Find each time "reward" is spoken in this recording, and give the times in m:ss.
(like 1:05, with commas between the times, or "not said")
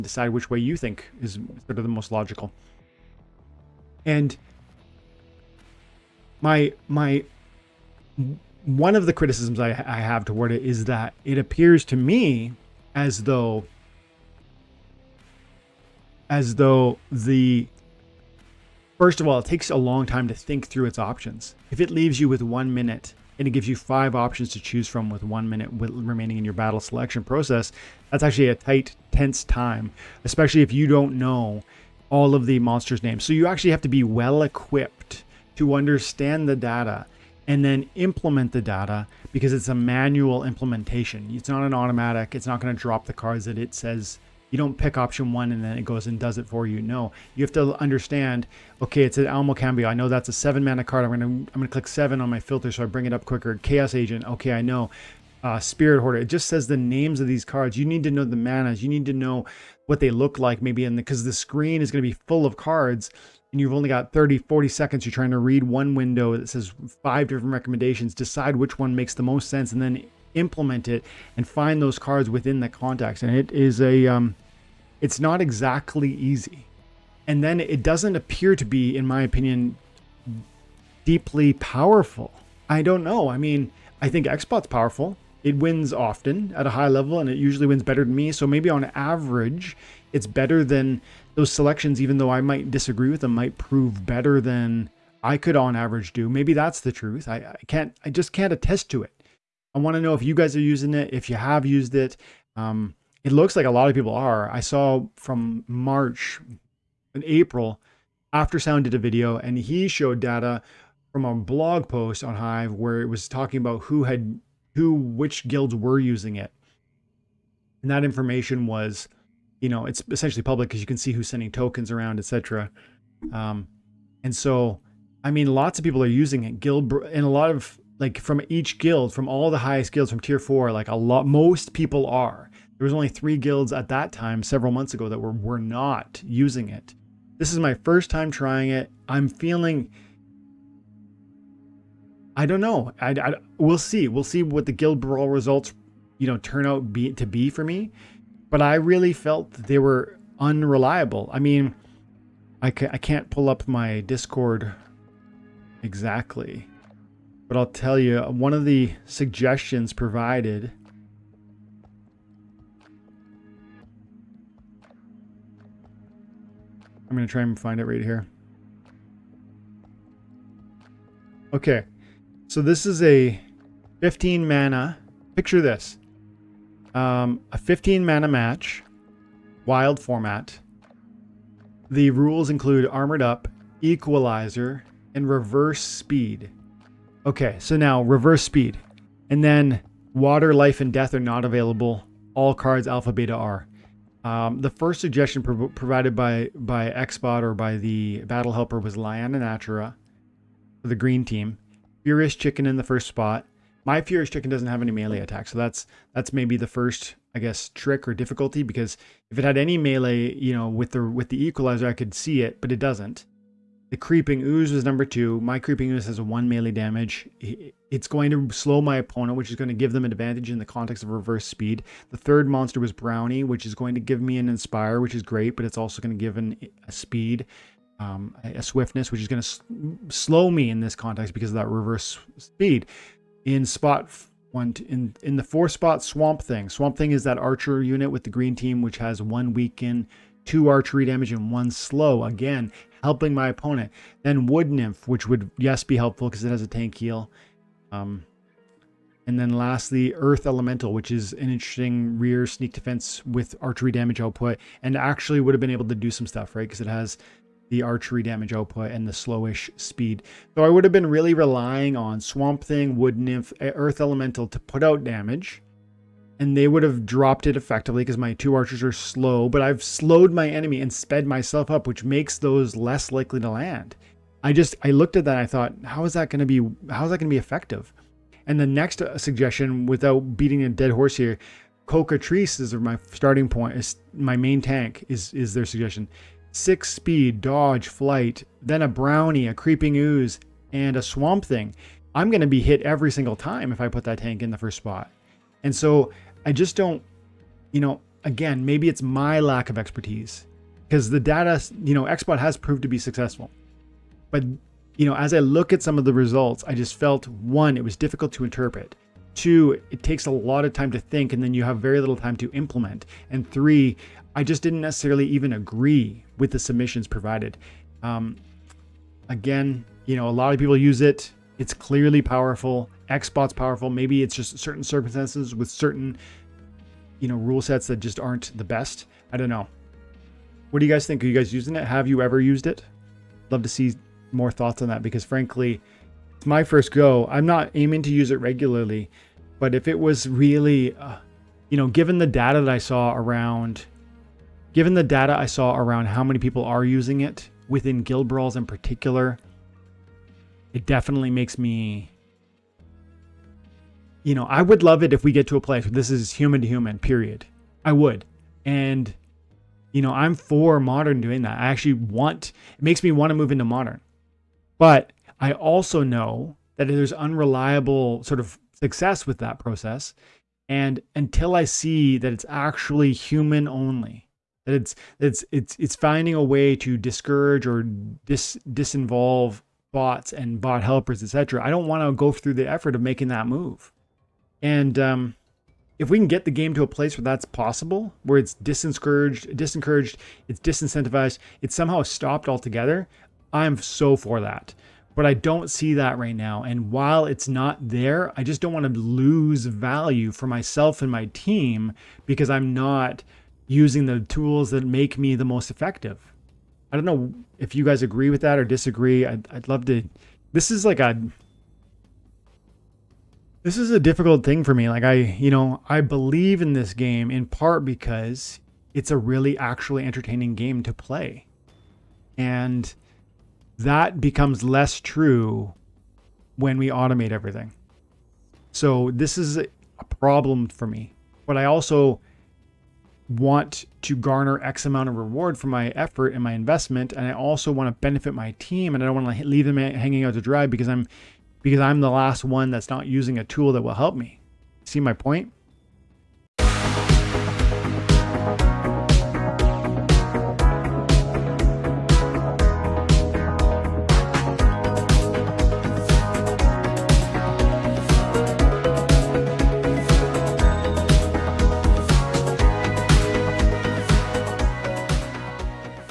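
7:15.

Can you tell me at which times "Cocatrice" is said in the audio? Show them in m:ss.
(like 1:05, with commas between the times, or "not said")
4:41.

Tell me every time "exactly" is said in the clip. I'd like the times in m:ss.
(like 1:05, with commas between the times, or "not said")
1:15, 2:35.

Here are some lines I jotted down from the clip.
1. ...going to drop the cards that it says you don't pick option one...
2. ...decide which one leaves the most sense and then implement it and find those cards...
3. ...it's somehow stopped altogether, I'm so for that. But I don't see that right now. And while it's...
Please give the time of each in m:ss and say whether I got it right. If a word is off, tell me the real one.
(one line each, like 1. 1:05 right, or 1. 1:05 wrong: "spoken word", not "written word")
1. 0:42 right
2. 1:08 wrong: "makes", not "leaves"
3. 6:31 right.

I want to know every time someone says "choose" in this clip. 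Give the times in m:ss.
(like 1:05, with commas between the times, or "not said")
0:24.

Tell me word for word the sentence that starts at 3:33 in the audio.
The Creeping Ooze was number two.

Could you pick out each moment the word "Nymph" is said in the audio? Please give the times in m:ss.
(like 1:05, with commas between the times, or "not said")
4:04, 4:23.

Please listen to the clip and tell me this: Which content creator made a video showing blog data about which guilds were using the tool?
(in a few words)
Aftersound.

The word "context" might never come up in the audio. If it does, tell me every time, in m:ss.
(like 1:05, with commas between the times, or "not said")
1:12, 3:40, 3:50.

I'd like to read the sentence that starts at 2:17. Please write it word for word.
This is my first time trying it.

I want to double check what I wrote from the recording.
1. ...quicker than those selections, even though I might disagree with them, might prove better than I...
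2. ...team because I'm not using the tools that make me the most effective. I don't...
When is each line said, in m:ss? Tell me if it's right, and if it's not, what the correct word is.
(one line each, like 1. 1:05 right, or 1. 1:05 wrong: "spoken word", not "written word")
1. 1:30 wrong: "better", not "quicker"
2. 6:41 right.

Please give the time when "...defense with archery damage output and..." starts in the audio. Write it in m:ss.
4:12.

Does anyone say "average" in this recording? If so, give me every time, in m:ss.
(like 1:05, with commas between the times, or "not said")
1:28, 1:35.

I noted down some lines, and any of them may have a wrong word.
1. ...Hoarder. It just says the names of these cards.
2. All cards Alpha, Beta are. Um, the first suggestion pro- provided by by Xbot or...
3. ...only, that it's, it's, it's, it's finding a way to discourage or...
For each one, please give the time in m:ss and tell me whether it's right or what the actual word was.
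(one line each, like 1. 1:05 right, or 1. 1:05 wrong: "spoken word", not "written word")
1. 0:56 right
2. 3:12 right
3. 6:13 right.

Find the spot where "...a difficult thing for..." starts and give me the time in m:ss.
6:53.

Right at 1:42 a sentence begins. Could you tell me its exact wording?
Um, it looks like a lot of people are.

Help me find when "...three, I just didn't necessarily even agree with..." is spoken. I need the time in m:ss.
5:13.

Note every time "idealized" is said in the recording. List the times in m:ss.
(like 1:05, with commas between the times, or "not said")
not said.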